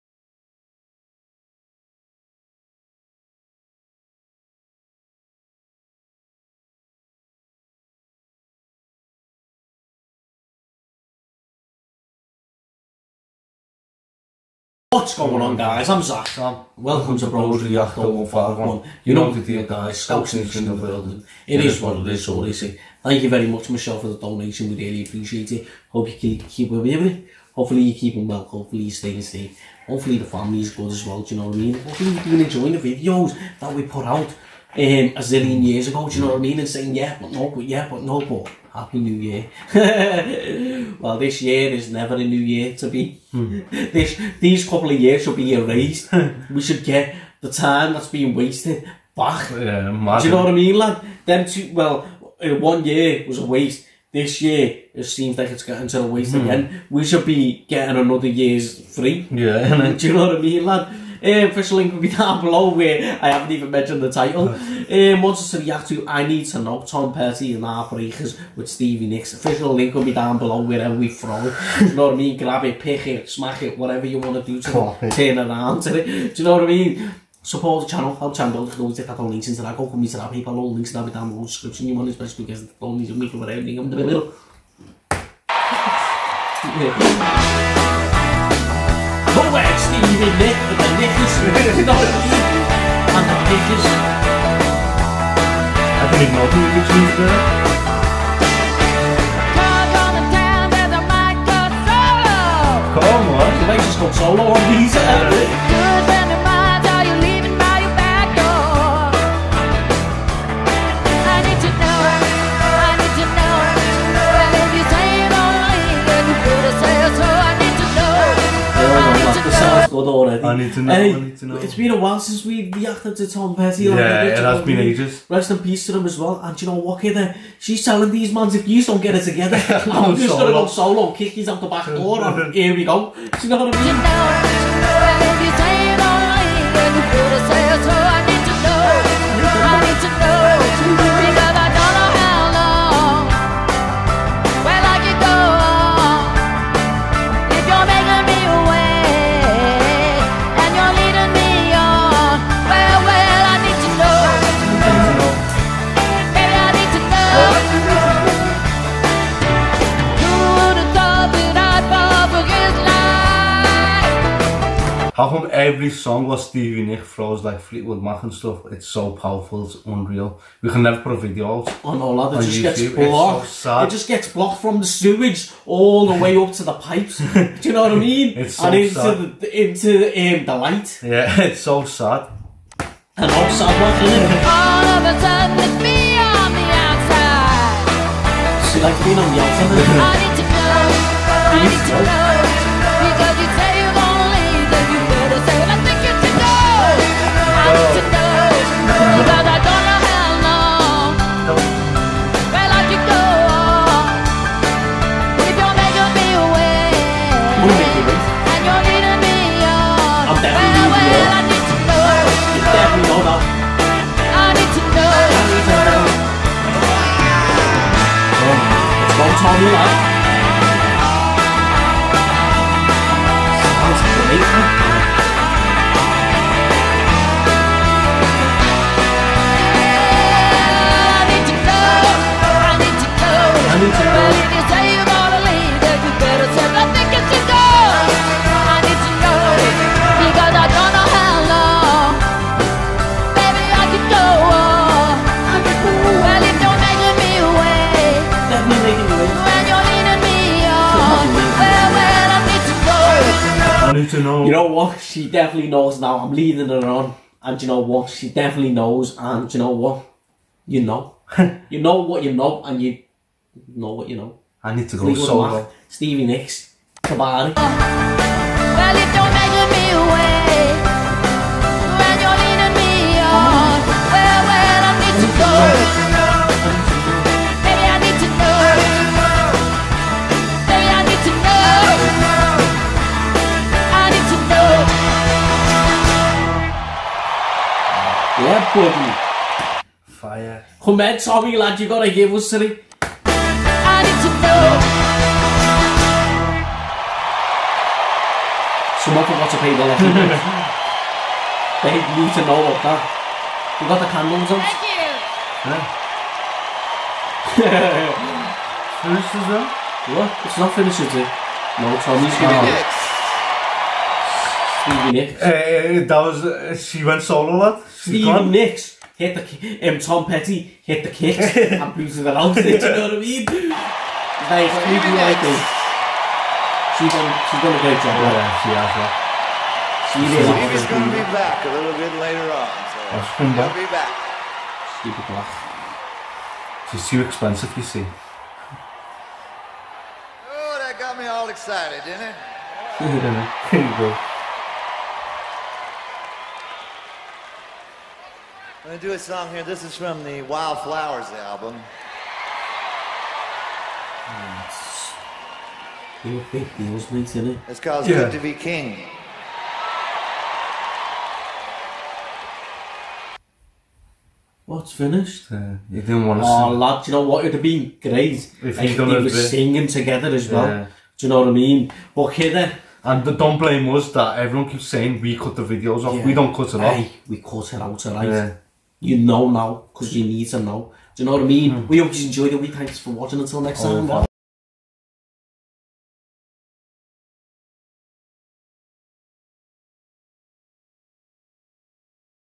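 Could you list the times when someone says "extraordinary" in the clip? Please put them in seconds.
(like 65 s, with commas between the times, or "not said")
not said.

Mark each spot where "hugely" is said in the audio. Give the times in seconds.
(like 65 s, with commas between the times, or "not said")
not said.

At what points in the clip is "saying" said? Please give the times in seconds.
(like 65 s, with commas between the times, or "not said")
36 s, 374 s.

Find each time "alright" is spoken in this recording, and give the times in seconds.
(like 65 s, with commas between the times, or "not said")
378 s.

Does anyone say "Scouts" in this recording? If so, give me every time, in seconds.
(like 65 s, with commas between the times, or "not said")
20 s.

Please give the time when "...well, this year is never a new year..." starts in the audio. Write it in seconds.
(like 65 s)
40 s.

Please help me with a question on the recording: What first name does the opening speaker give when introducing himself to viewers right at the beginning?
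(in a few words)
Zach.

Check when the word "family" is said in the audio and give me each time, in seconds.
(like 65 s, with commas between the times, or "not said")
30 s.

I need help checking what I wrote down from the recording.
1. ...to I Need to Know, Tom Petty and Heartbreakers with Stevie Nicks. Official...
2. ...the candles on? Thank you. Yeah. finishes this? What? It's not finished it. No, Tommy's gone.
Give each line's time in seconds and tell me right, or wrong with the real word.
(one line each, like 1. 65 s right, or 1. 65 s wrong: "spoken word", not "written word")
1. 65 s right
2. 303 s right.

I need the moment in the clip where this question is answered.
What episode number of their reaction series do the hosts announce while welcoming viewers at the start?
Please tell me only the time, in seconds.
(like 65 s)
17 s.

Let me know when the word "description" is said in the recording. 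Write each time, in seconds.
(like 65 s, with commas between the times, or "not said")
81 s.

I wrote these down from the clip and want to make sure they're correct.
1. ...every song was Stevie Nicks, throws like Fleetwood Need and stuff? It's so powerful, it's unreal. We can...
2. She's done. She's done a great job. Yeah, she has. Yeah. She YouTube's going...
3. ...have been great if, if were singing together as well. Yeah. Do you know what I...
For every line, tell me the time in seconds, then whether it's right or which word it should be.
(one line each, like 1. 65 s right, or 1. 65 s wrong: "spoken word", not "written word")
1. 165 s wrong: "Mac", not "Need"
2. 326 s wrong: "Stevie", not "YouTube"
3. 367 s right.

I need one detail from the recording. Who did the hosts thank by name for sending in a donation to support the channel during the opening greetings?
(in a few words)
Michelle.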